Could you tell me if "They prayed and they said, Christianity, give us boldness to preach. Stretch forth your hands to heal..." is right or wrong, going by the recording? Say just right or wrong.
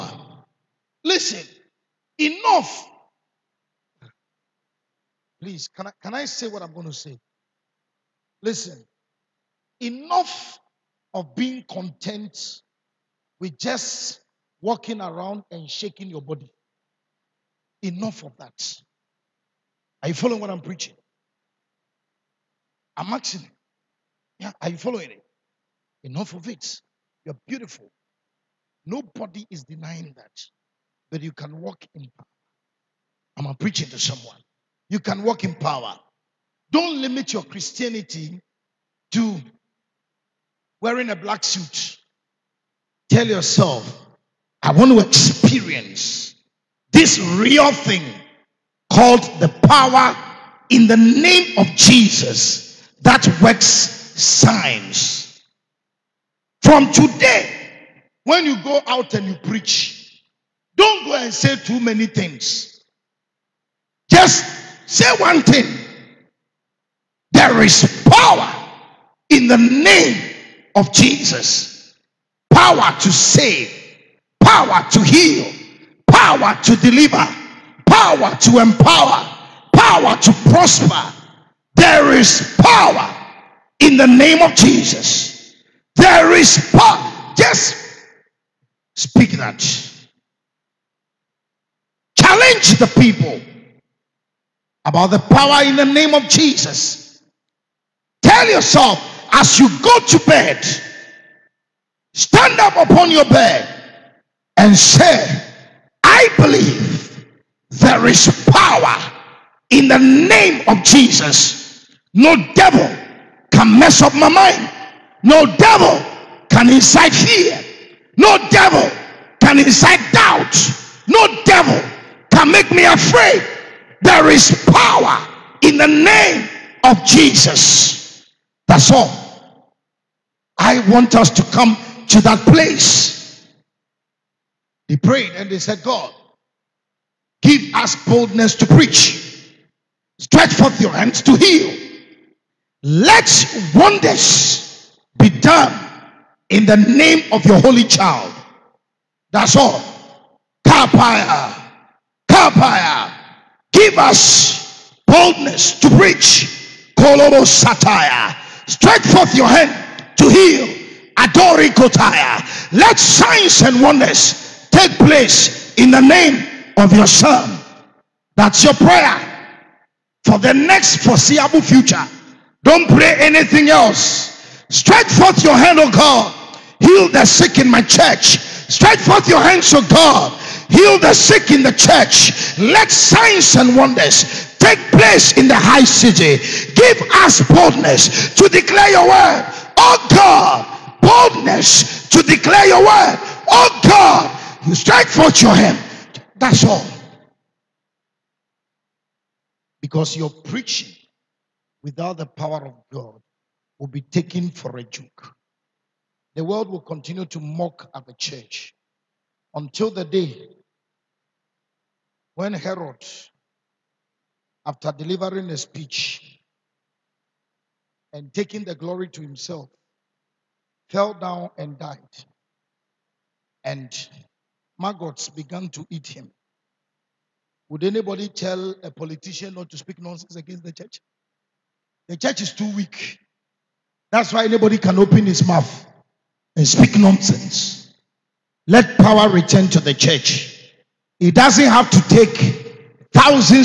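wrong.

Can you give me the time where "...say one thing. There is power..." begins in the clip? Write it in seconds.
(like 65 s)
64 s.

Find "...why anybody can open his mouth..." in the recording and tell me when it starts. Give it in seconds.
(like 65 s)
234 s.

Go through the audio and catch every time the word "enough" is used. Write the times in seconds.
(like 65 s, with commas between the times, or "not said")
2 s, 9 s, 17 s, 26 s.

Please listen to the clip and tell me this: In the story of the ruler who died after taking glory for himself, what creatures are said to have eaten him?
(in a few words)
Maggots.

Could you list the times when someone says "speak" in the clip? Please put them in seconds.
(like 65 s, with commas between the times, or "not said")
88 s, 229 s, 236 s.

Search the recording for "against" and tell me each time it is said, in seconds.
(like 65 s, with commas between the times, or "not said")
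230 s.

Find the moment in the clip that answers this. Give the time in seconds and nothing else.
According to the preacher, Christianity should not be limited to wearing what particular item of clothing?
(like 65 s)
41 s.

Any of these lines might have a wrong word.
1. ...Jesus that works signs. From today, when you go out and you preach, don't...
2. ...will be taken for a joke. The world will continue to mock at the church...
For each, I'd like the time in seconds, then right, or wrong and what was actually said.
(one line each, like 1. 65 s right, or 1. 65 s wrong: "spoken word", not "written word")
1. 51 s right
2. 203 s right.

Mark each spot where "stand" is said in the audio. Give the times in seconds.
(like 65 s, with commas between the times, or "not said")
102 s.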